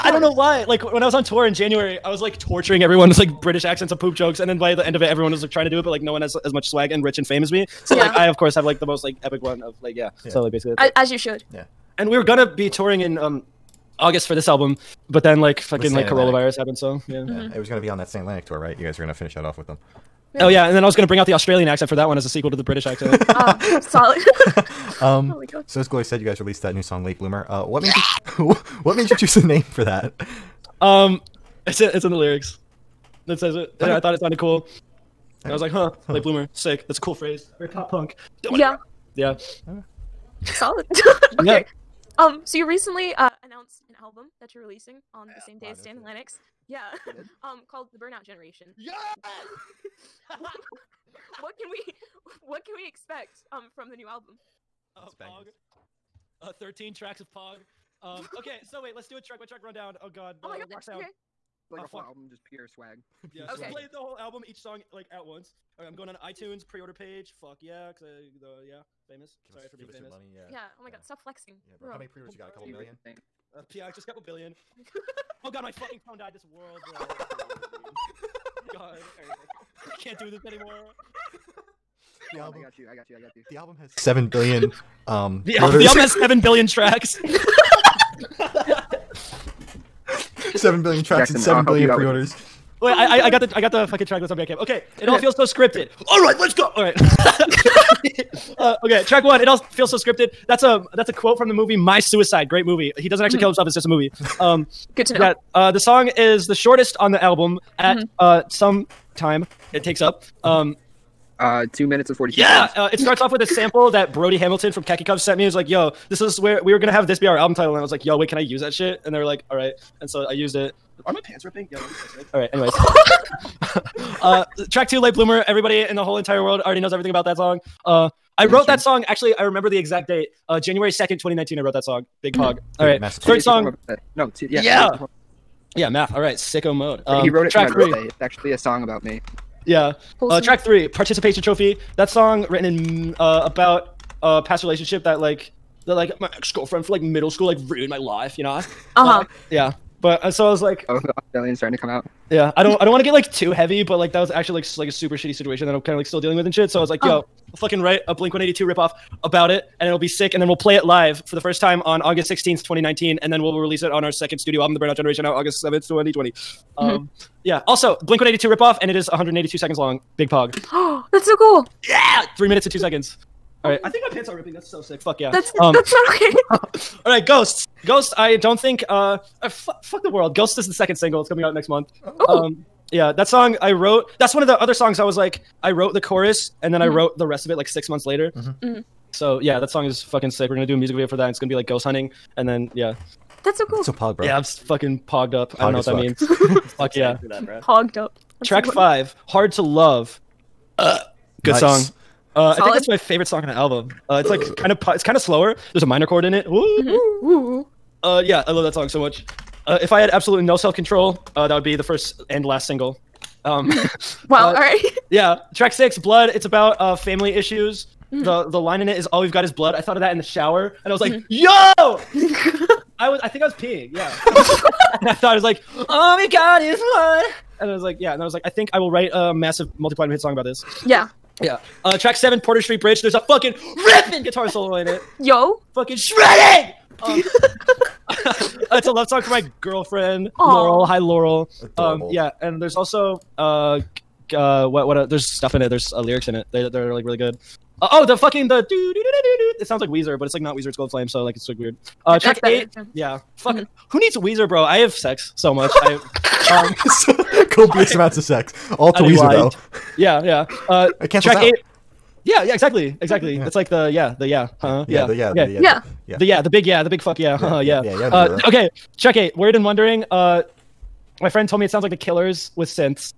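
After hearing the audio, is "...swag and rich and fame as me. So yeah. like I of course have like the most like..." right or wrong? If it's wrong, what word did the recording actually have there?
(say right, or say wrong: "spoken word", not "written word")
right.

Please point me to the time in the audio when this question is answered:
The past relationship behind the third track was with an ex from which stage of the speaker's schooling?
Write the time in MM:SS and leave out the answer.
02:27.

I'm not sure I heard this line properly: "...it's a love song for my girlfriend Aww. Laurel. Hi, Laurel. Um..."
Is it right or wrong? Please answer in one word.
right.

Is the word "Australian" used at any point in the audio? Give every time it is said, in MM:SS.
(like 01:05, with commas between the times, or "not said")
00:21, 02:31.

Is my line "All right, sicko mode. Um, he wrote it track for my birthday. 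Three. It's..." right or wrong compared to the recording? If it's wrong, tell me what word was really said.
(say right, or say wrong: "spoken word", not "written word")
right.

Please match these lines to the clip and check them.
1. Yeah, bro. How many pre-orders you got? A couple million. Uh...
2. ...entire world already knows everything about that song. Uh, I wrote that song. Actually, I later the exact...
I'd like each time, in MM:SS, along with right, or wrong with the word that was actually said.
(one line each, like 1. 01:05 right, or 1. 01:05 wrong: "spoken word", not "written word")
1. 01:11 right
2. 02:06 wrong: "remember", not "later".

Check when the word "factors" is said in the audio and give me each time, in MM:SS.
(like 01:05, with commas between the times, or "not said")
not said.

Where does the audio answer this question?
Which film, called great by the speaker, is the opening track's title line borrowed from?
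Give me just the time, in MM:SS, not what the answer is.
01:41.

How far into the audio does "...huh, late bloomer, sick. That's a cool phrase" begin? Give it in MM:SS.
00:35.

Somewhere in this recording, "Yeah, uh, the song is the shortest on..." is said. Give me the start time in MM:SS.
01:45.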